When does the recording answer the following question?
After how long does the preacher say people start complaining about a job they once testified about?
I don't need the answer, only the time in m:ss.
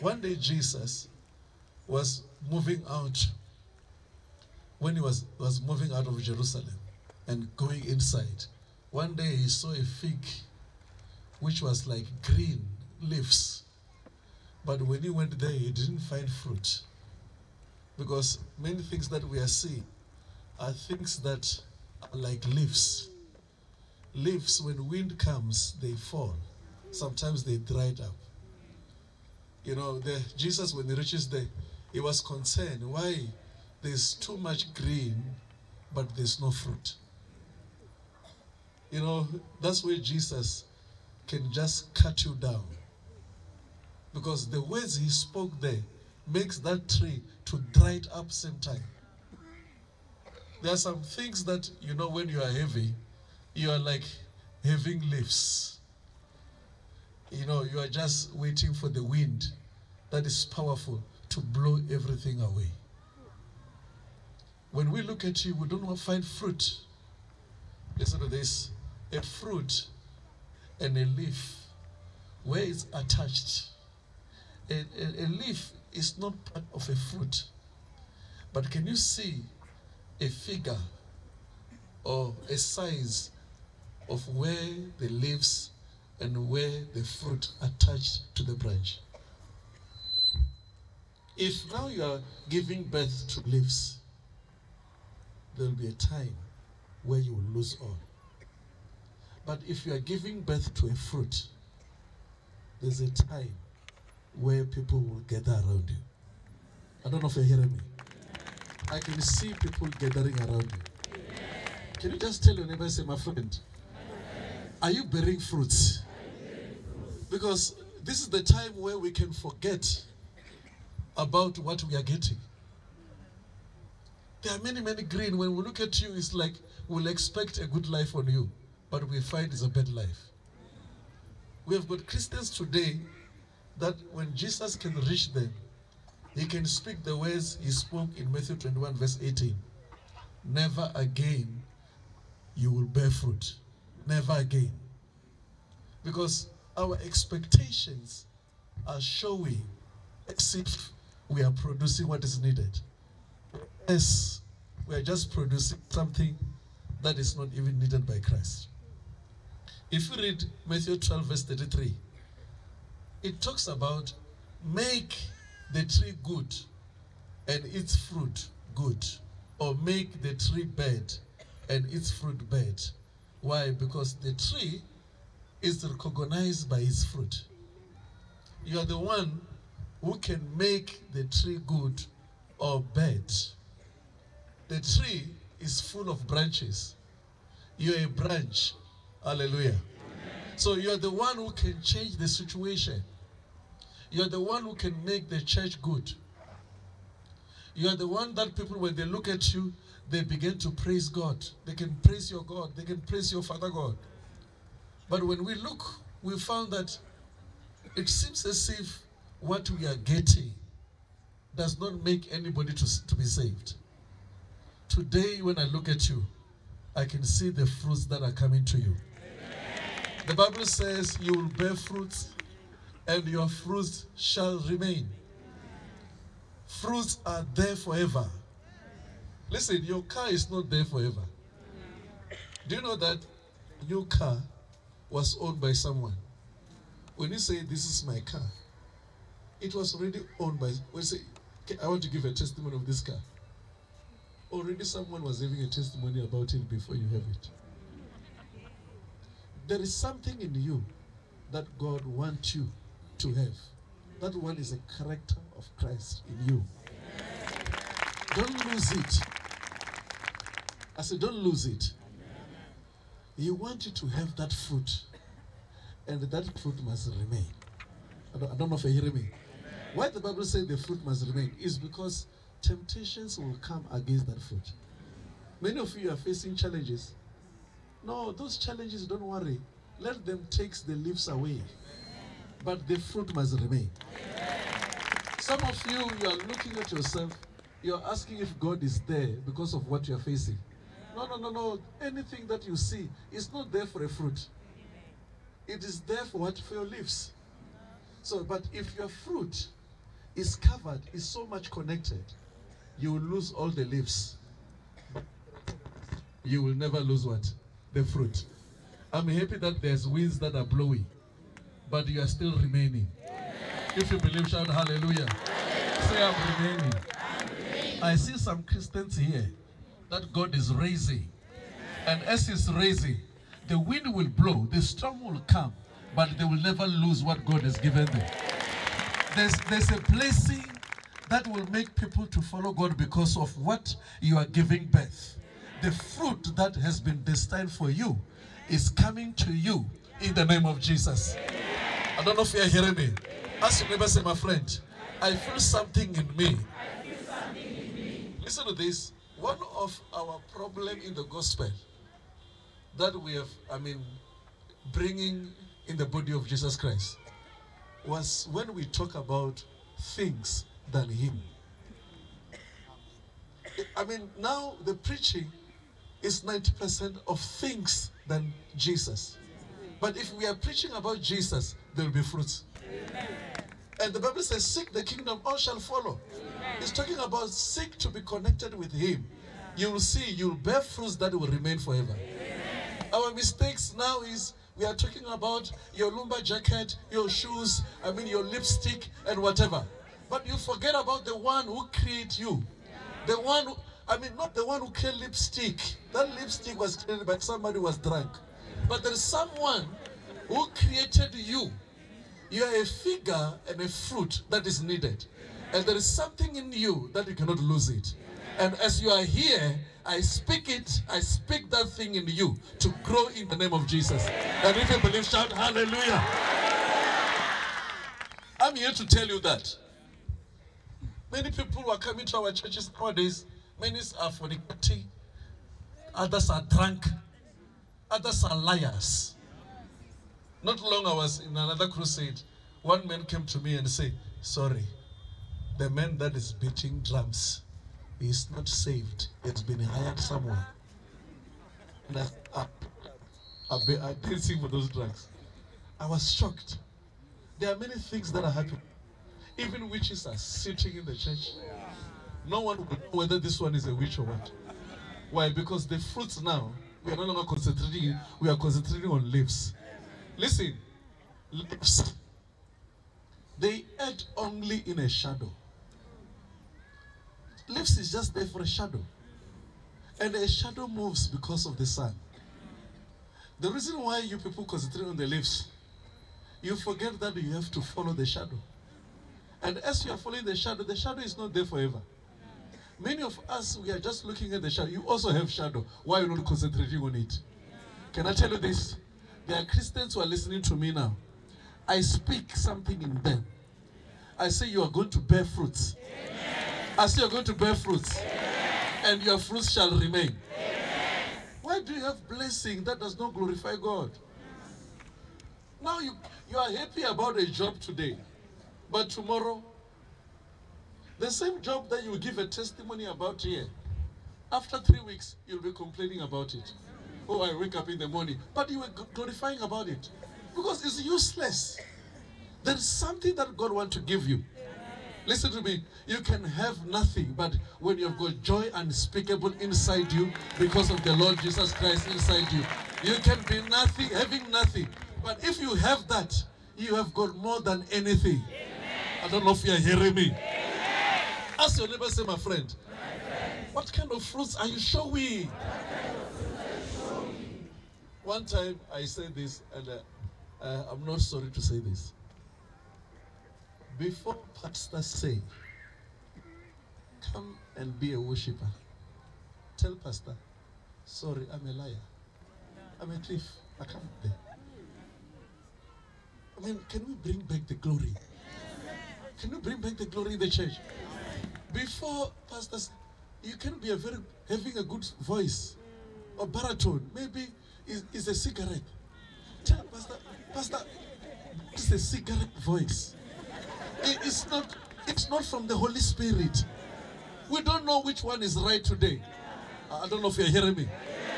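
8:34.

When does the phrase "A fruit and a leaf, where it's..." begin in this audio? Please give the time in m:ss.
1:09.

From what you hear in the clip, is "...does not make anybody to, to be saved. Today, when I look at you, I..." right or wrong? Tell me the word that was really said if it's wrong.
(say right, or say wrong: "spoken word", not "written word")
right.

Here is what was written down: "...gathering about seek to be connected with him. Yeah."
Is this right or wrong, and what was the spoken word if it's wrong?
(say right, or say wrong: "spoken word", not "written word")
wrong: "talking", not "gathering".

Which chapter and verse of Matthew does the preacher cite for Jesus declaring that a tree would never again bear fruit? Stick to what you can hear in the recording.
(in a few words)
Matthew 21:18.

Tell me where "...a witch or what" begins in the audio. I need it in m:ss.
7:33.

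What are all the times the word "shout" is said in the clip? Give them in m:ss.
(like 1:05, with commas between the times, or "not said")
5:14, 6:55.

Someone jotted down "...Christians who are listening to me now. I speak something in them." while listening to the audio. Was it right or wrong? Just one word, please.
right.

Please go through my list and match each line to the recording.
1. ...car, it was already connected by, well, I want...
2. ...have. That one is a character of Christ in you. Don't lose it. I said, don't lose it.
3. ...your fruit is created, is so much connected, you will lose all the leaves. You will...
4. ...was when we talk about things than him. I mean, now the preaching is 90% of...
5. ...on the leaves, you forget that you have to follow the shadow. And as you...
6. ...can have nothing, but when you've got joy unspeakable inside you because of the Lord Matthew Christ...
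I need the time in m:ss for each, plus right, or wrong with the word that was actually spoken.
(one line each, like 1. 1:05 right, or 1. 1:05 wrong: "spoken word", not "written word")
1. 3:58 wrong: "owned", not "connected"
2. 4:13 right
3. 4:58 wrong: "covered", not "created"
4. 5:58 right
5. 7:55 right
6. 8:46 wrong: "Jesus", not "Matthew".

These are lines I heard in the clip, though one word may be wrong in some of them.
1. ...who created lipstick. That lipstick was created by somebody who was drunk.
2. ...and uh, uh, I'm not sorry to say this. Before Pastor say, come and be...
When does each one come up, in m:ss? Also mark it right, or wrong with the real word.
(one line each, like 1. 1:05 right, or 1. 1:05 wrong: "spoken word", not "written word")
1. 6:34 right
2. 9:09 right.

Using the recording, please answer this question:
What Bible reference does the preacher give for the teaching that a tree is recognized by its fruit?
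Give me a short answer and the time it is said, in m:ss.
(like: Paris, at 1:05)
Matthew 12:33, at 2:40.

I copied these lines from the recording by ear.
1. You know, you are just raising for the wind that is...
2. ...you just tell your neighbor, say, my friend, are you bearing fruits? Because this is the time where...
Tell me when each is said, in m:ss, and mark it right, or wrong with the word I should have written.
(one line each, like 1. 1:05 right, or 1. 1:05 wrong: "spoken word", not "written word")
1. 0:57 wrong: "waiting", not "raising"
2. 1:52 right.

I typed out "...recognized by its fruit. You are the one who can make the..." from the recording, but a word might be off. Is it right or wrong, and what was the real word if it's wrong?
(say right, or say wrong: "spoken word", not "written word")
right.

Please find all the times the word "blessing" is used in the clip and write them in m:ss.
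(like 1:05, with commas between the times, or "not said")
5:30, 8:22.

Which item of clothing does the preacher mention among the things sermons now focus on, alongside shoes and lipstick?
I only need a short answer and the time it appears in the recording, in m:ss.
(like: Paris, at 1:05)
Lumber jacket, at 6:26.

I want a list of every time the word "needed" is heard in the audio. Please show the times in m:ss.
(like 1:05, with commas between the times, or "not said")
2:32, 2:37, 6:44.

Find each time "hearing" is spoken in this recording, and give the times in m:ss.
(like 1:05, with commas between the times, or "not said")
1:47, 4:28, 5:42, 8:59, 9:50.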